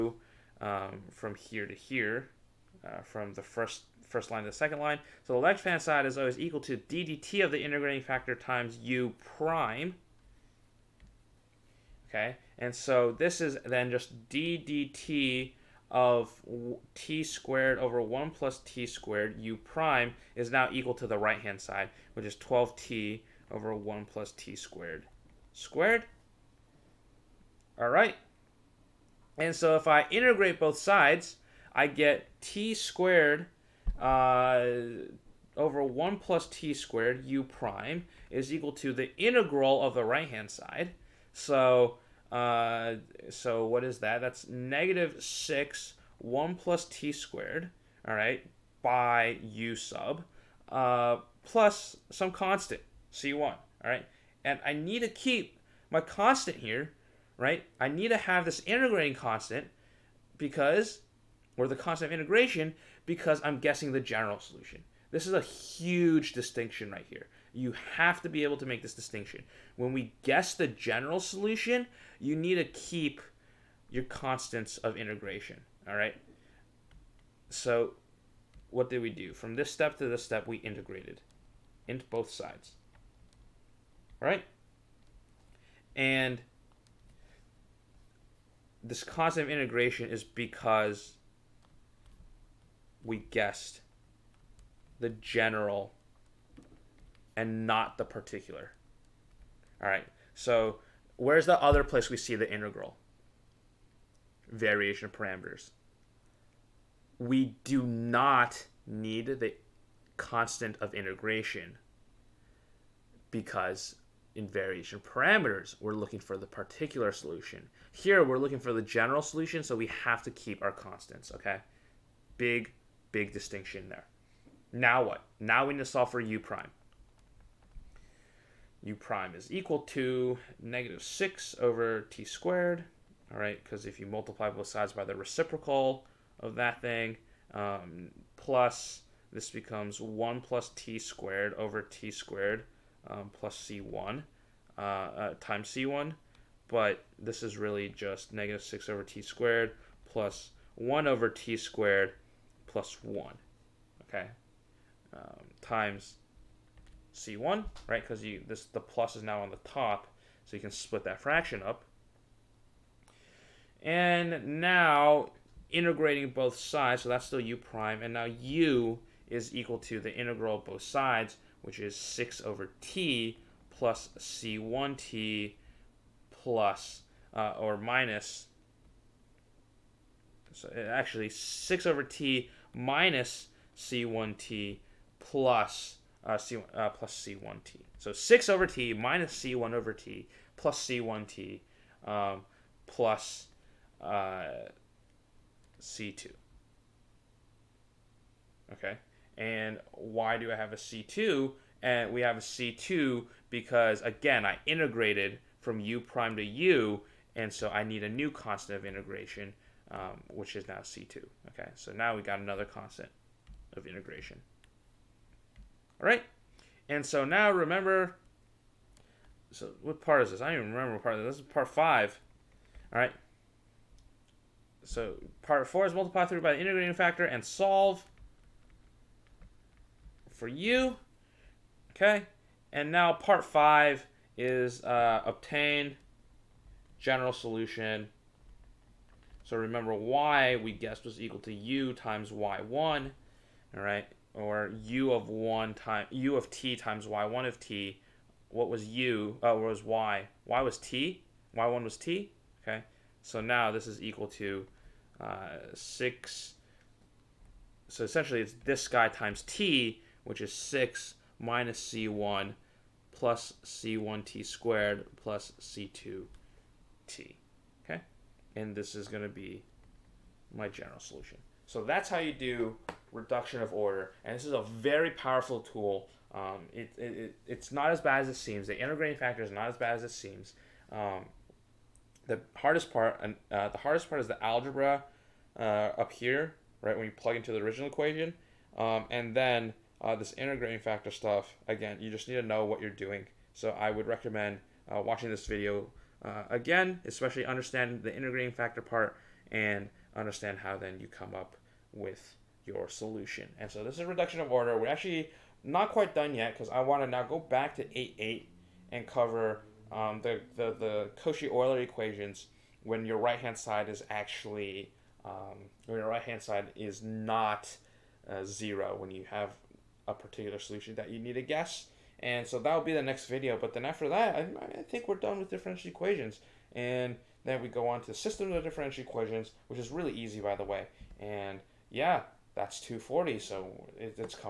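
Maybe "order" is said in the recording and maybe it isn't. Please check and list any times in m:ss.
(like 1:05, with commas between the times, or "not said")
4:33, 5:04.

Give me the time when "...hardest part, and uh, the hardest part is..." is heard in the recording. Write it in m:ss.
4:42.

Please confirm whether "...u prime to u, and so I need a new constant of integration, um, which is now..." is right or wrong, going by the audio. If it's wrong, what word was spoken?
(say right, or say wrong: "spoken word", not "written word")
right.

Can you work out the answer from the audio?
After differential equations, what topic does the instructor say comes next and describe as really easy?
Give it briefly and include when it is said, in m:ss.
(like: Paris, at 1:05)
system of differential equations, at 5:28.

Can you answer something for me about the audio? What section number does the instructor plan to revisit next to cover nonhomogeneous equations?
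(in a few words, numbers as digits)
8-8.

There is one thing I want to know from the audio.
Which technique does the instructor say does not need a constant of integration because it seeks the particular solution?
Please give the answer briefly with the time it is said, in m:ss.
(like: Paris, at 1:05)
Variation of parameters, at 1:44.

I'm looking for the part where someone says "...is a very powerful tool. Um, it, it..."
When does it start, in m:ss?
4:34.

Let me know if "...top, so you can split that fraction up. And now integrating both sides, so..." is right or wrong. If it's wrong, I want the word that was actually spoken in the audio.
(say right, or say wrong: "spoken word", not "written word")
right.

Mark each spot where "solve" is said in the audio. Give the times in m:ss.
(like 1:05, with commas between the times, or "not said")
2:05, 3:47.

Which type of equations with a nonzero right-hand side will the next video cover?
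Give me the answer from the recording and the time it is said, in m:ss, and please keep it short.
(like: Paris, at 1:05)
Cauchy-Euler equations, at 5:11.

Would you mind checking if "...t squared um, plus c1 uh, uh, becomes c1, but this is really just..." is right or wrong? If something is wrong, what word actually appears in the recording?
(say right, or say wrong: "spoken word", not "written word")
wrong: "times", not "becomes".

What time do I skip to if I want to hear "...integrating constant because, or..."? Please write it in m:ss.
0:58.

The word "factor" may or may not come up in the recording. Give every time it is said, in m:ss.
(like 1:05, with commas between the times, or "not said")
0:08, 3:46, 4:39, 4:50, 4:58.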